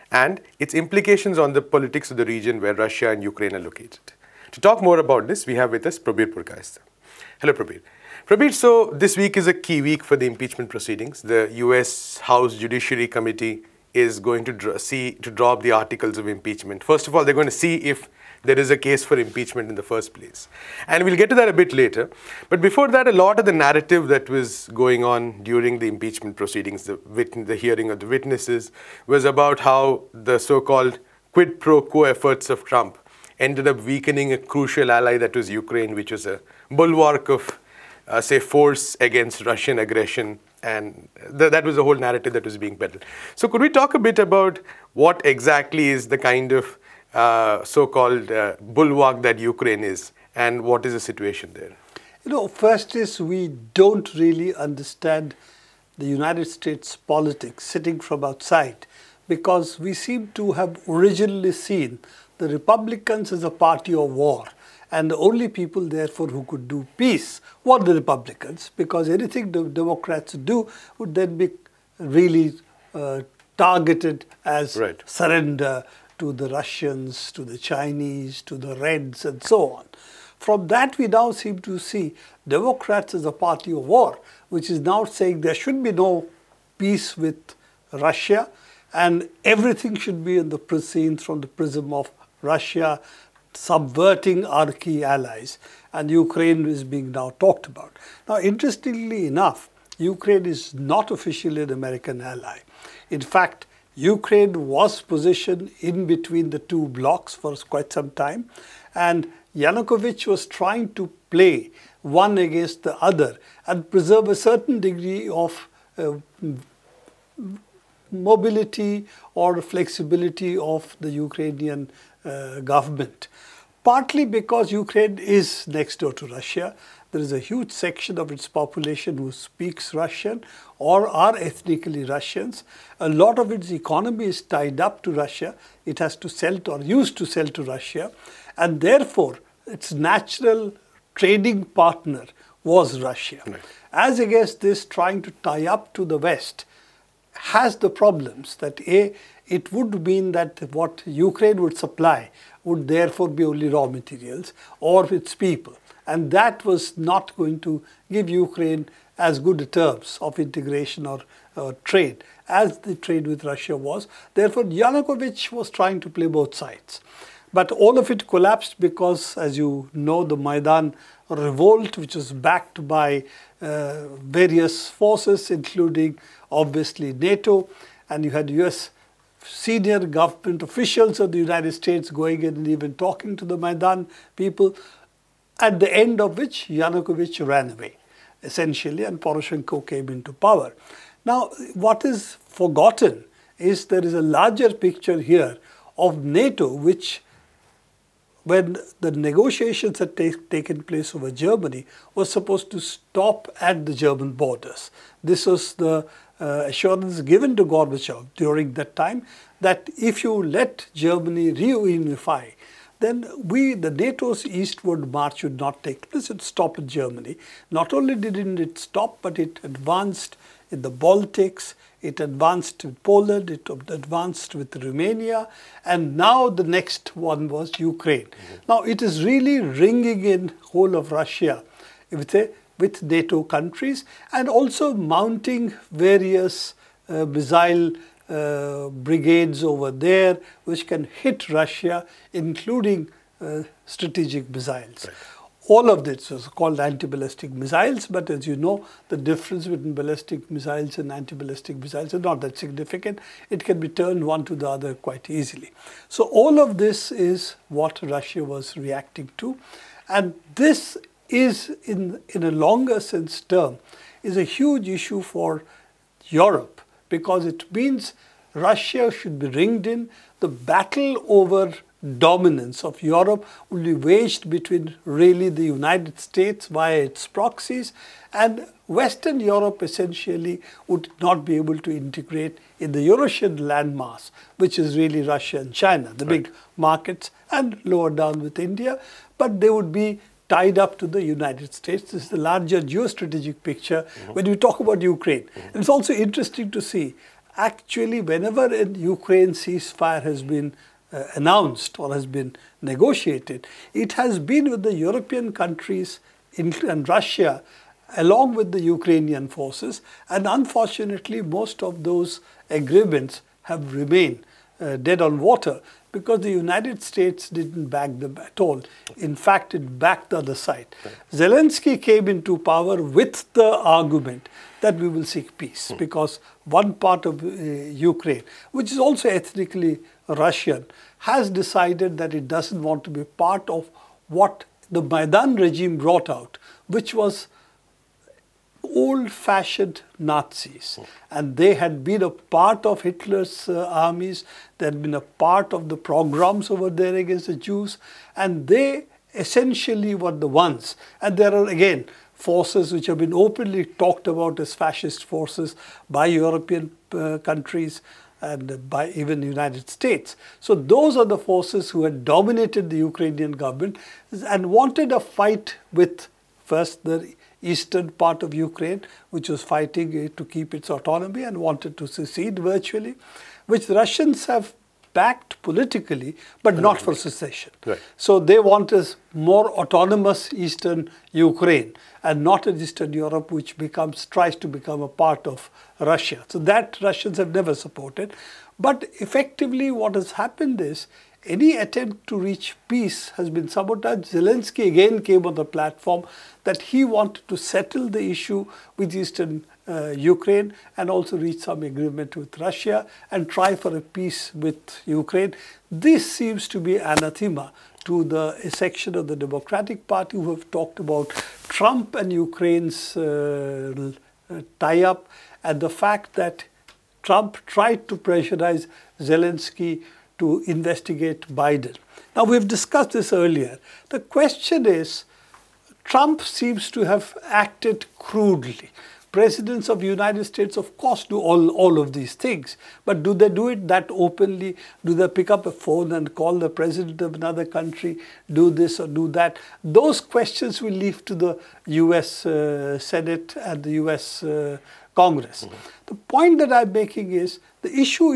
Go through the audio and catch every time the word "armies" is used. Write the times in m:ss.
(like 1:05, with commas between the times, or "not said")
5:43.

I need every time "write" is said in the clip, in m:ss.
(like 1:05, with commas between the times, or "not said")
not said.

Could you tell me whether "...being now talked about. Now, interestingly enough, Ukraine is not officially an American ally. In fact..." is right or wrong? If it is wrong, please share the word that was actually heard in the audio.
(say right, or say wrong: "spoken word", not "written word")
right.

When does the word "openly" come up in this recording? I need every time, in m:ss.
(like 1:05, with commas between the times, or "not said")
5:53, 7:14.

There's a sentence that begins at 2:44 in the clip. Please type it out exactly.
Therefore, Yanukovych was trying to play both sides.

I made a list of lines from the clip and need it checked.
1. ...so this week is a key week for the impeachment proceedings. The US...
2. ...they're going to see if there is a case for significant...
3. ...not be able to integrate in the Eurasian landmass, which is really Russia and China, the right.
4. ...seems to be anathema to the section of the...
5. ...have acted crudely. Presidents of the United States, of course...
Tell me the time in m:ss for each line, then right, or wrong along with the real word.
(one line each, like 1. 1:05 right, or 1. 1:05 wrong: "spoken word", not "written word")
1. 0:08 right
2. 0:17 wrong: "impeachment", not "significant"
3. 4:41 right
4. 6:46 right
5. 7:07 right.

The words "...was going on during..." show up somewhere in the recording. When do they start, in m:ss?
0:24.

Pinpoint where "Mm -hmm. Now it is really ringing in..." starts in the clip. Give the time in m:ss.
3:48.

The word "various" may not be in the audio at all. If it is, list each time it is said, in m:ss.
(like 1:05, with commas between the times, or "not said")
2:54, 3:55.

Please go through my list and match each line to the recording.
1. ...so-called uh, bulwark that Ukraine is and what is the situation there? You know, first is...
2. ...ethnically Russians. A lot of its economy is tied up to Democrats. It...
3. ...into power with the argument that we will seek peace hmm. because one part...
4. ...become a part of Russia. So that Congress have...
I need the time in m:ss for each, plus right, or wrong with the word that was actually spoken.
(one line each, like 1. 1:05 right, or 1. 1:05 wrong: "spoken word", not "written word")
1. 0:47 right
2. 2:11 wrong: "Russia", not "Democrats"
3. 5:22 right
4. 6:24 wrong: "Russians", not "Congress".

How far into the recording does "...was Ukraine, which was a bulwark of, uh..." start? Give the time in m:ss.
0:35.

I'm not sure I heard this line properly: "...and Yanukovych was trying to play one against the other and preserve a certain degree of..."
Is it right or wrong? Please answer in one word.
right.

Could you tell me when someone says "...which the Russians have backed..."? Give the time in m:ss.
6:13.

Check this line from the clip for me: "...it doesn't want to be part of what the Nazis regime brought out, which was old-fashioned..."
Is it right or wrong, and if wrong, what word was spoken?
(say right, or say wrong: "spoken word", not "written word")
wrong: "Maidan", not "Nazis".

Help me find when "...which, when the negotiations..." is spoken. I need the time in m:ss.
3:16.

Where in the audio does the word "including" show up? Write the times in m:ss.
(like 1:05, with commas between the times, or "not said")
2:55, 4:02.